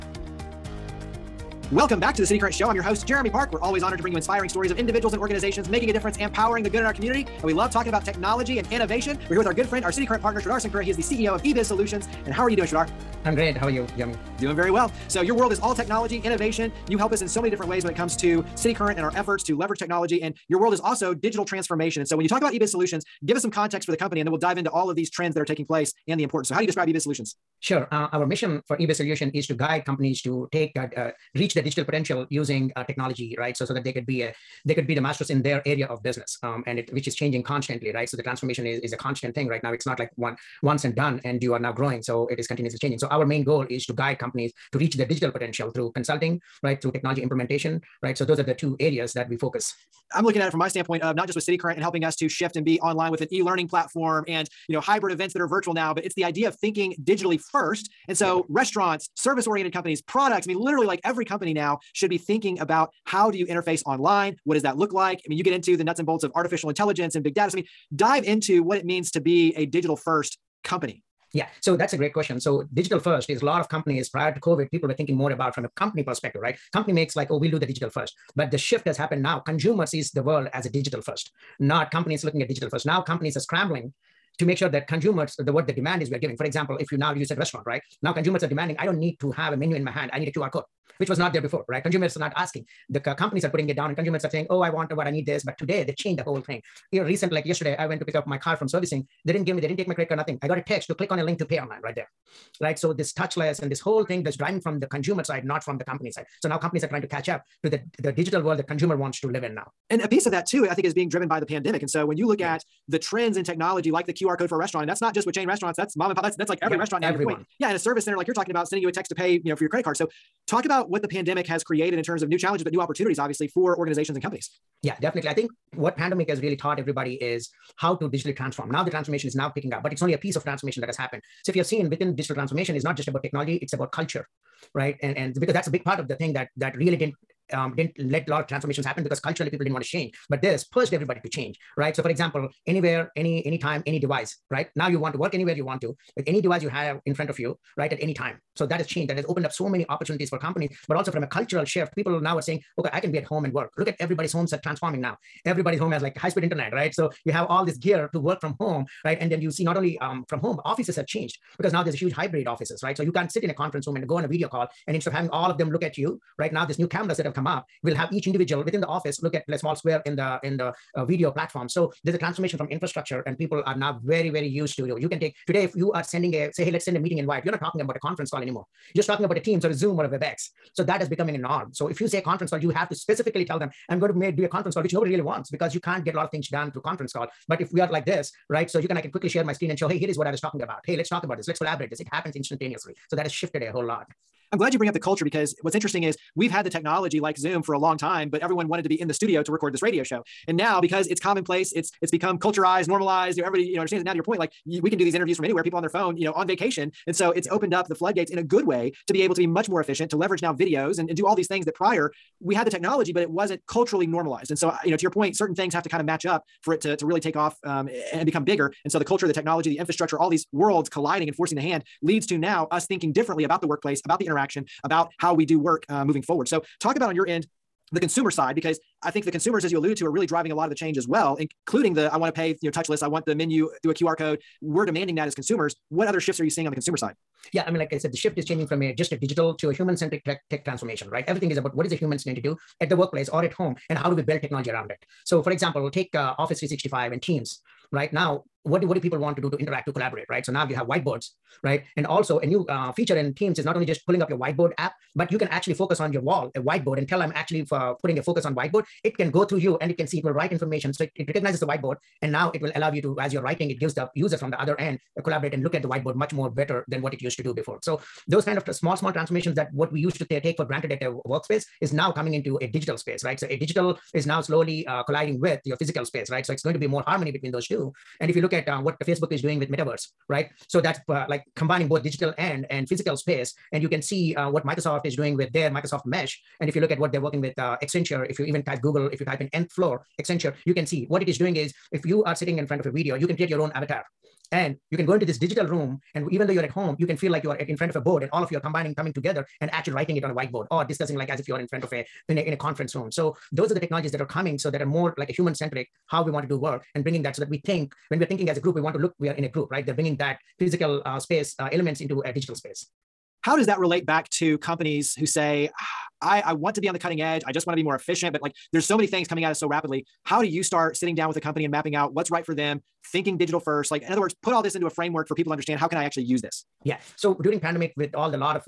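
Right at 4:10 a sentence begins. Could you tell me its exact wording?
So now you have whiteboards, right?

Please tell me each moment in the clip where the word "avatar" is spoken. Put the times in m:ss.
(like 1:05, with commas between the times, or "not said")
4:53.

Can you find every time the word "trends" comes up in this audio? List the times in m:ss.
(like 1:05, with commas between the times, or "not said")
0:25, 1:52.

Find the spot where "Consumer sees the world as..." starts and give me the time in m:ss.
1:19.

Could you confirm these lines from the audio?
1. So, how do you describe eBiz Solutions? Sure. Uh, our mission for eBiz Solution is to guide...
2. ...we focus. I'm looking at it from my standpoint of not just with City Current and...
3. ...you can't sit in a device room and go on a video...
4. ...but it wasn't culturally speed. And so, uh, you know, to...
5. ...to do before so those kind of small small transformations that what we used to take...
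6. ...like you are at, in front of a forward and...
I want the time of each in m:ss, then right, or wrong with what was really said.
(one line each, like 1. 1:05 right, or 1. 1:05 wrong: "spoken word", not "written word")
1. 0:26 right
2. 0:49 right
3. 2:43 wrong: "conference", not "device"
4. 3:33 wrong: "normalized", not "speed"
5. 4:27 right
6. 4:57 wrong: "board", not "forward".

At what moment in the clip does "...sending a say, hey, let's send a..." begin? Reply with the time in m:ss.
2:56.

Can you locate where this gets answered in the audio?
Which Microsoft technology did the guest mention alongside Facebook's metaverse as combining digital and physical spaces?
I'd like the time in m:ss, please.
4:45.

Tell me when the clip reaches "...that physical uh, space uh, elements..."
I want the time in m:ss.
5:10.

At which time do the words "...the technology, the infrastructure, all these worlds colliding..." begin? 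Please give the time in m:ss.
3:39.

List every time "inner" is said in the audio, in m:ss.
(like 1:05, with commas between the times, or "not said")
not said.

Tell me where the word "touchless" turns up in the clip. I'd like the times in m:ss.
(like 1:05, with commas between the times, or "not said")
1:43, 3:52.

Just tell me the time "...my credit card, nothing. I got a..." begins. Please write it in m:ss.
1:39.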